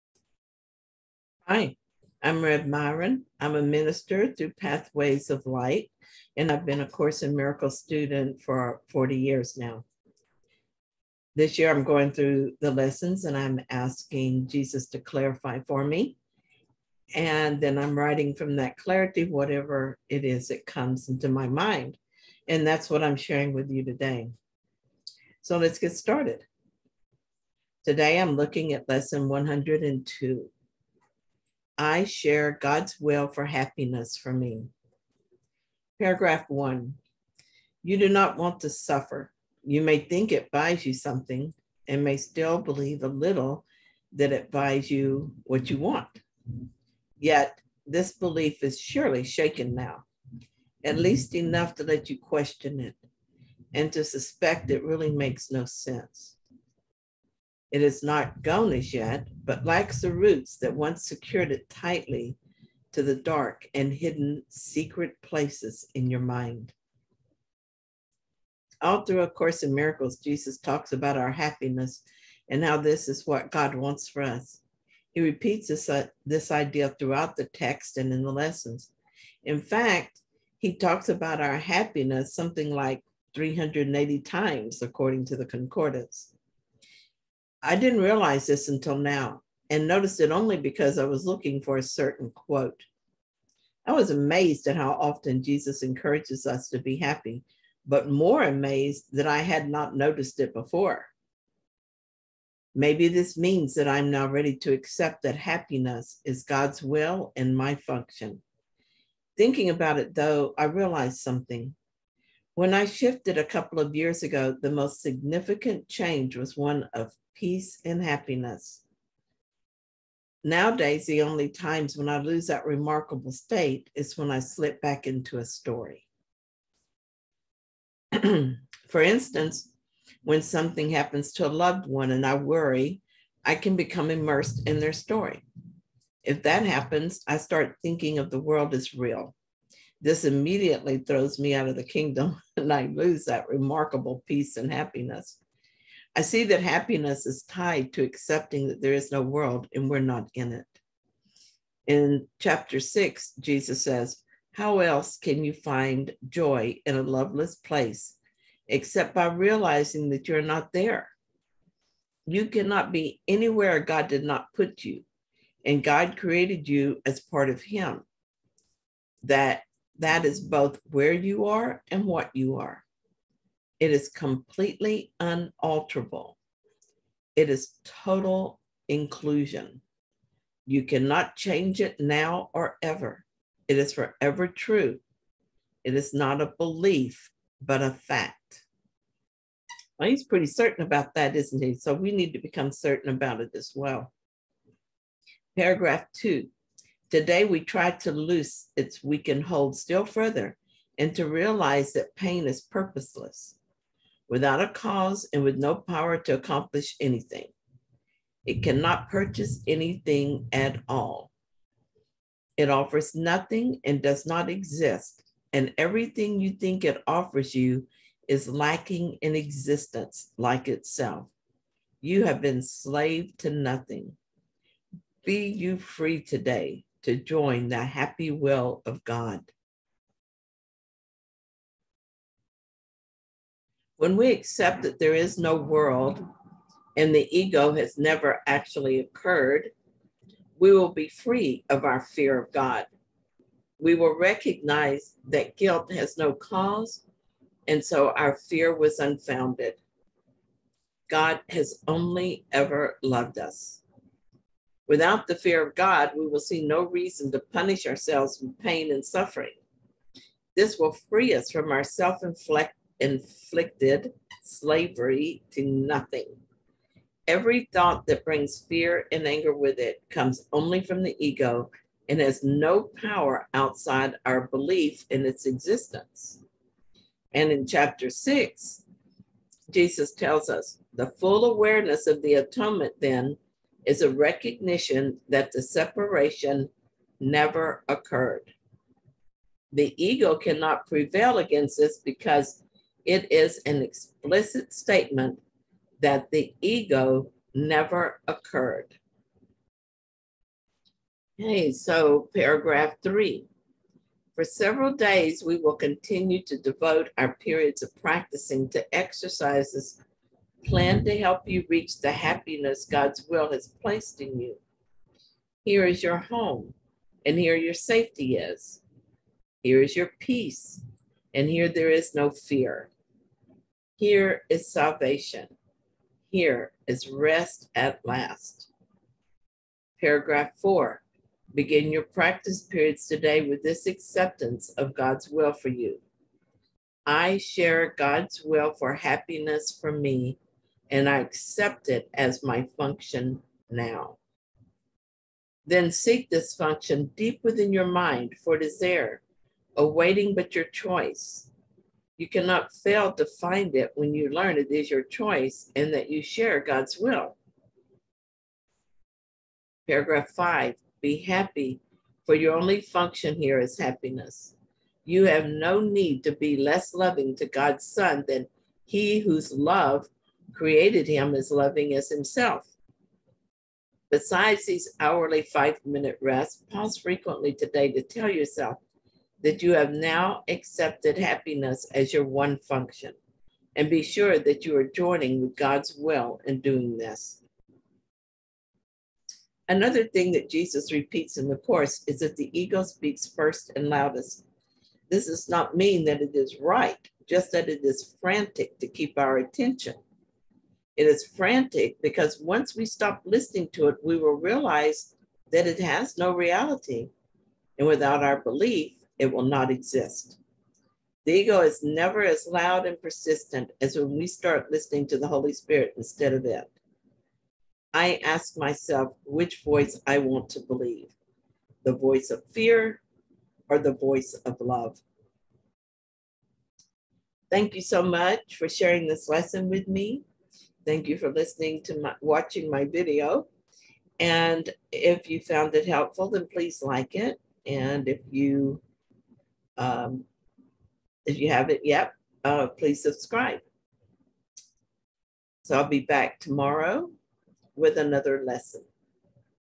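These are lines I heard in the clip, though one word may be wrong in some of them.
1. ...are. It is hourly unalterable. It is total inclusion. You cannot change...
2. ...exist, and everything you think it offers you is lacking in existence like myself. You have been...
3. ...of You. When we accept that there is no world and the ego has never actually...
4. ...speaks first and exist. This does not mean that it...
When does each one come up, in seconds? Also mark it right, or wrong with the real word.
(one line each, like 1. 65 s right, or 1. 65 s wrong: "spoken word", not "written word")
1. 172 s wrong: "completely", not "hourly"
2. 214 s wrong: "itself", not "myself"
3. 228 s wrong: "God", not "You"
4. 392 s wrong: "loudest", not "exist".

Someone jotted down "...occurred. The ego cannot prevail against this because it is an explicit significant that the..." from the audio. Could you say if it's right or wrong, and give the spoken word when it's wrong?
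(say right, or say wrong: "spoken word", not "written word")
wrong: "statement", not "significant".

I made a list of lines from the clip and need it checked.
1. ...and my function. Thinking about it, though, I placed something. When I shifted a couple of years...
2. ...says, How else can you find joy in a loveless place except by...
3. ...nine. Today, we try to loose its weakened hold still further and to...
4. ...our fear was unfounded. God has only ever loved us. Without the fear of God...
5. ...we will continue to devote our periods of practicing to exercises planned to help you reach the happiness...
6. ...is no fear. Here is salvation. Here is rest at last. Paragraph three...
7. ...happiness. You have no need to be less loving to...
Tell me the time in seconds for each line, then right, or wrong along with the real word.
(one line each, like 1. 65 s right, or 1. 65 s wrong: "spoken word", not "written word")
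1. 107 s wrong: "realized", not "placed"
2. 153 s right
3. 196 s wrong: "two", not "nine"
4. 248 s right
5. 305 s right
6. 321 s wrong: "four", not "three"
7. 363 s right.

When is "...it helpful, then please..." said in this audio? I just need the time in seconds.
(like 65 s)
435 s.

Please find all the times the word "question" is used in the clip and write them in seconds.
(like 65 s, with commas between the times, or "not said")
52 s.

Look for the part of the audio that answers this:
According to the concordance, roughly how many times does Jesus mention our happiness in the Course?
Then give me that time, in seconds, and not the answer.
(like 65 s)
83 s.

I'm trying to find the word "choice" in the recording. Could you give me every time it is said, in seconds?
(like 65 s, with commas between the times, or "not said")
350 s, 355 s.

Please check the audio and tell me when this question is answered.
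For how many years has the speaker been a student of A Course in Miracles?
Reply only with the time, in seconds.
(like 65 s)
8 s.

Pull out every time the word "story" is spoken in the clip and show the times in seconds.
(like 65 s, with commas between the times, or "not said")
125 s, 134 s.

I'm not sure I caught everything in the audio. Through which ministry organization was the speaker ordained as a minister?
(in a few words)
Pathways of Light.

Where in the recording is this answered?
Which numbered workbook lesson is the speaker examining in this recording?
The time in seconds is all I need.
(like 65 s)
28 s.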